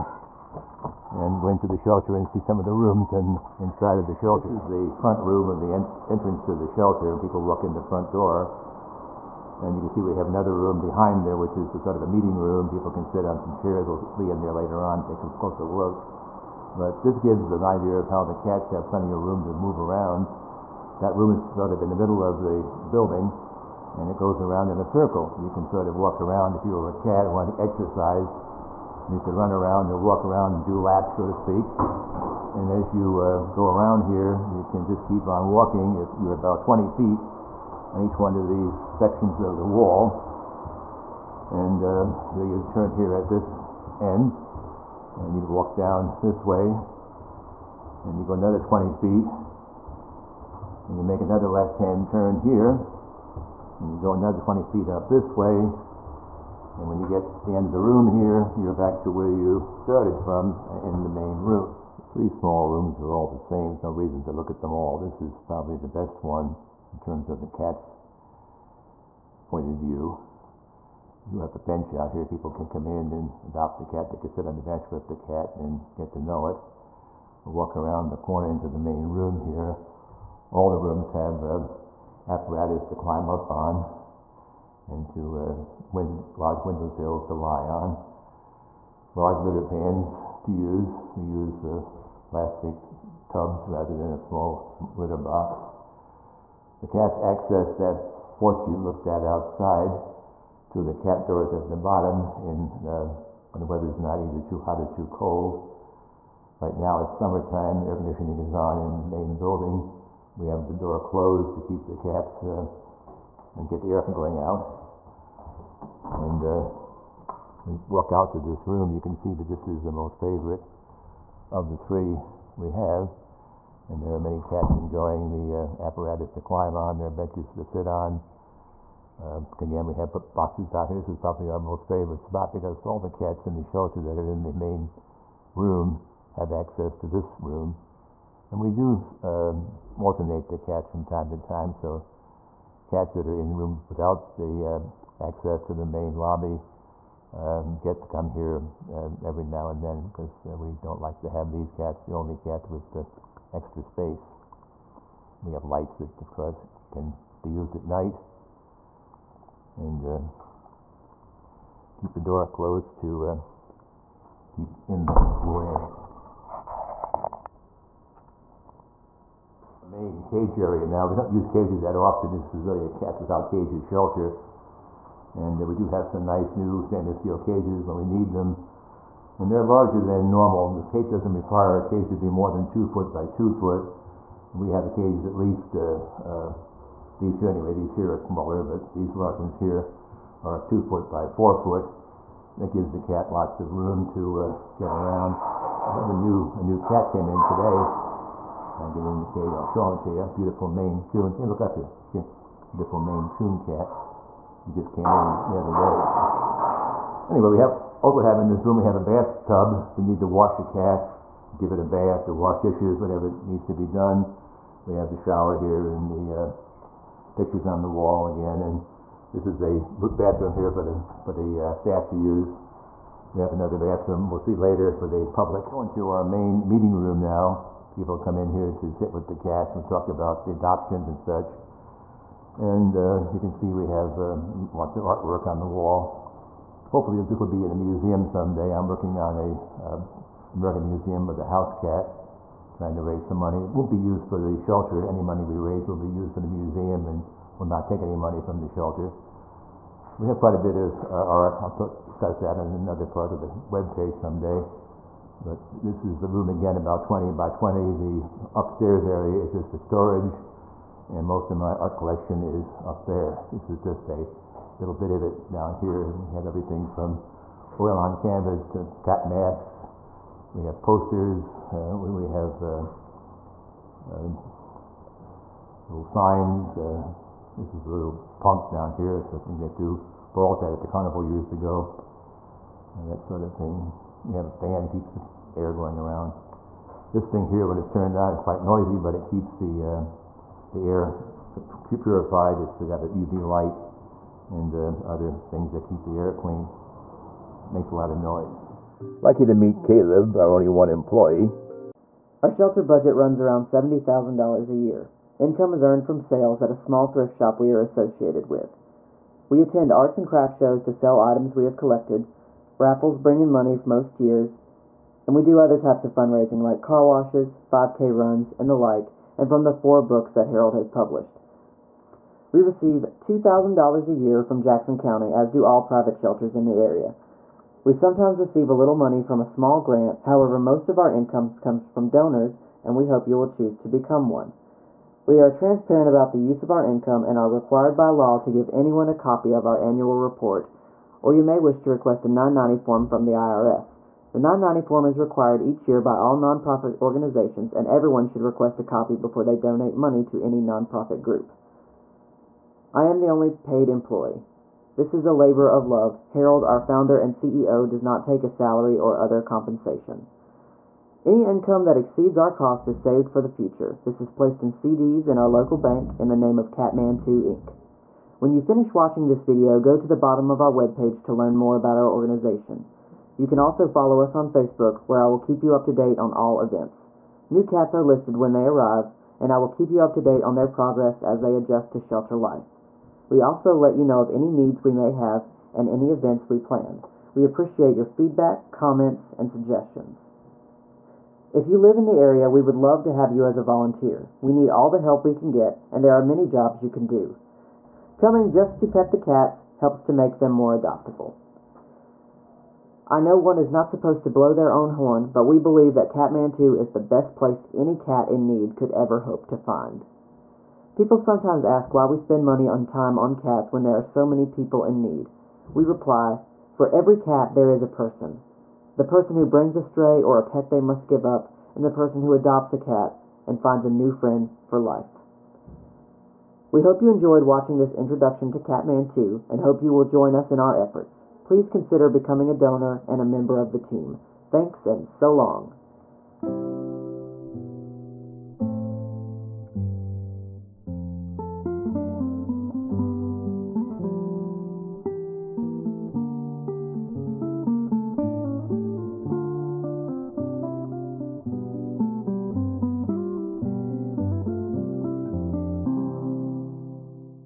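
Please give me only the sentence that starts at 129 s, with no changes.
Uh, again, we have boxes out here.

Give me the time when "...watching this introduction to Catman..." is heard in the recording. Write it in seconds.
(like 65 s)
427 s.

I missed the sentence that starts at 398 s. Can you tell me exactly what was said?
Coming just to pet the cats helps to make them more adoptable.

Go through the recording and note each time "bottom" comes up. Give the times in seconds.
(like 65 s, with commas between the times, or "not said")
101 s, 370 s.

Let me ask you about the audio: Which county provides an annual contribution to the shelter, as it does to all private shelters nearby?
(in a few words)
Jackson County.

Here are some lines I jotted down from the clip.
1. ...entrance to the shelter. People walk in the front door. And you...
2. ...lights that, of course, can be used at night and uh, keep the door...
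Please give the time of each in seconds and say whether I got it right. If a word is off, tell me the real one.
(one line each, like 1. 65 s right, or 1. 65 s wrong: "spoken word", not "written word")
1. 6 s right
2. 155 s right.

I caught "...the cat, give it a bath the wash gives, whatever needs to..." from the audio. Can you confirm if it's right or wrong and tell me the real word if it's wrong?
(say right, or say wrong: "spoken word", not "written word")
wrong: "dishes", not "gives".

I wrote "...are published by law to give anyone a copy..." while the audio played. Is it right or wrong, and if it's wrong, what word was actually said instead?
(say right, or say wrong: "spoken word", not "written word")
wrong: "required", not "published".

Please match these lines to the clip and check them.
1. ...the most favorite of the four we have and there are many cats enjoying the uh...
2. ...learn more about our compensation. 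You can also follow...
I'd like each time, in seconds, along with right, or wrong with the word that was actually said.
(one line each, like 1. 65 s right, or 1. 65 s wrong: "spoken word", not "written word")
1. 119 s wrong: "three", not "four"
2. 371 s wrong: "organization", not "compensation".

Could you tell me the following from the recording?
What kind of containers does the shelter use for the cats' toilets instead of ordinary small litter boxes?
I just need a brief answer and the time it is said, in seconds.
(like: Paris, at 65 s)
plastic tubs, at 92 s.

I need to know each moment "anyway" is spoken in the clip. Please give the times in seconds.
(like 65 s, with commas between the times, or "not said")
187 s, 207 s.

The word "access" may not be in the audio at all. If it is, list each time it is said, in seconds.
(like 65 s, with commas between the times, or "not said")
97 s, 136 s, 145 s.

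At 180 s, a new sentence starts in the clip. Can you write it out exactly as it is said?
This cage doesn't require a cage to be more than two foot by two foot.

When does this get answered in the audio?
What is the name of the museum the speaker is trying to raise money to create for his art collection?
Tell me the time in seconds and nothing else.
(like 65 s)
240 s.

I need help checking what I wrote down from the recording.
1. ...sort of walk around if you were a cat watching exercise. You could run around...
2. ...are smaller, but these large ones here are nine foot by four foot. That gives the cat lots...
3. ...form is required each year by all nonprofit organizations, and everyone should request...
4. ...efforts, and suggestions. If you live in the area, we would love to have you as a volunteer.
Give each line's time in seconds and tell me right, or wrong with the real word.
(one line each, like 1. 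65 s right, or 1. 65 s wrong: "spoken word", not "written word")
1. 25 s wrong: "wanting", not "watching"
2. 188 s wrong: "two", not "nine"
3. 344 s right
4. 388 s wrong: "comments", not "efforts".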